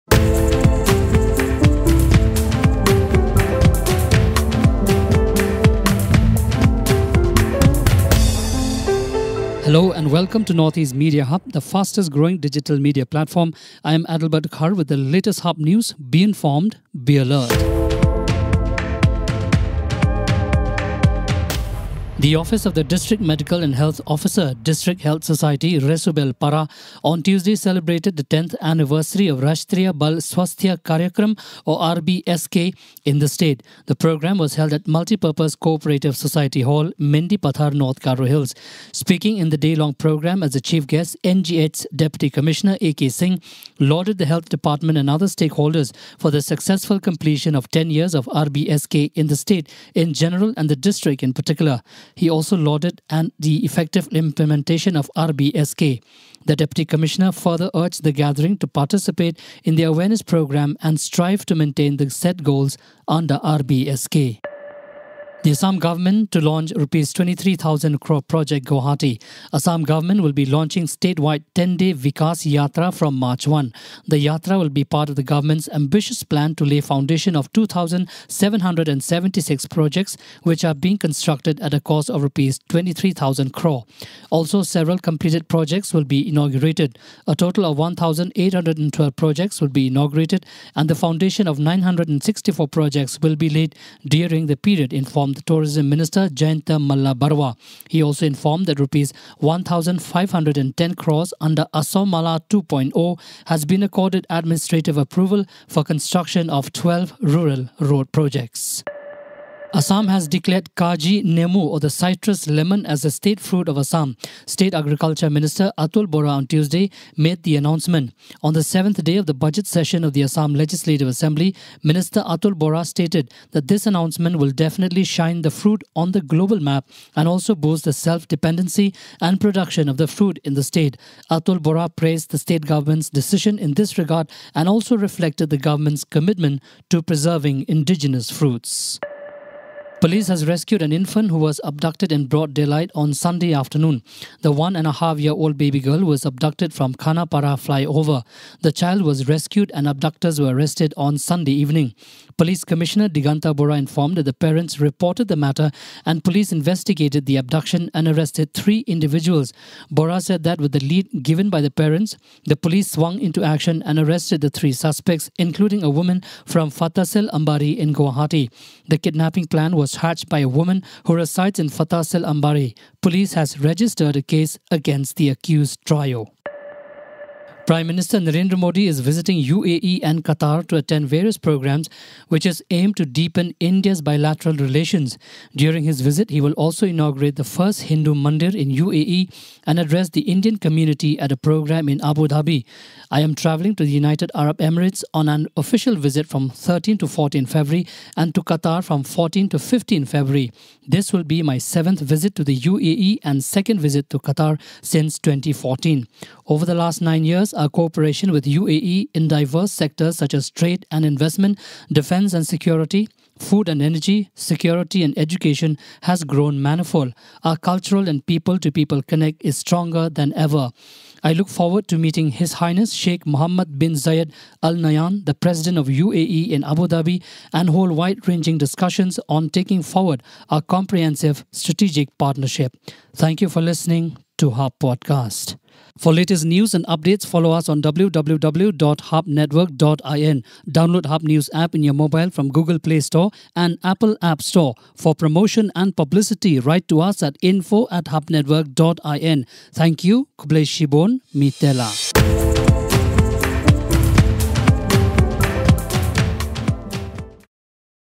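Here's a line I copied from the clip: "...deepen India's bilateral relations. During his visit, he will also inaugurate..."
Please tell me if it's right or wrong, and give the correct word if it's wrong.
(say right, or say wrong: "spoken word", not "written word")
right.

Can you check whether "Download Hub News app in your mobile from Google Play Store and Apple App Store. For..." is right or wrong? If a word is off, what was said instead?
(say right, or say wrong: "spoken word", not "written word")
right.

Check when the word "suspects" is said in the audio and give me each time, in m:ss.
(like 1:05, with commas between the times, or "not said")
2:44.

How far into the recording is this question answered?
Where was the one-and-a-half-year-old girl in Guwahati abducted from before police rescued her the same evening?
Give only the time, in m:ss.
2:26.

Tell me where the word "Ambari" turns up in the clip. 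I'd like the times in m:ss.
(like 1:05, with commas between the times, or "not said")
2:47, 2:52.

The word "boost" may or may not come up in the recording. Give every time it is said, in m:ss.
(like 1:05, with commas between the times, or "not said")
2:07.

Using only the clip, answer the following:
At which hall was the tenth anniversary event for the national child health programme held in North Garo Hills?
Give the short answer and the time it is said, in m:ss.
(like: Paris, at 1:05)
Multipurpose Cooperative Society Hall, at 0:34.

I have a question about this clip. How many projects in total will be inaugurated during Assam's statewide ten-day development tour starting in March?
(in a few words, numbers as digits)
1812.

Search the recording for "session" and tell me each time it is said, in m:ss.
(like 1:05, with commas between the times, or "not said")
1:59.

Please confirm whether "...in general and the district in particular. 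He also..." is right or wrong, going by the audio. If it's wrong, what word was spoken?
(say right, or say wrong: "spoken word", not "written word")
right.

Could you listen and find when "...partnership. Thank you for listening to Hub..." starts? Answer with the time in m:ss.
3:52.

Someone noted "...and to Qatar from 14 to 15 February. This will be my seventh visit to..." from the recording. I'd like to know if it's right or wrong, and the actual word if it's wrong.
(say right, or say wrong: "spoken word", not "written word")
right.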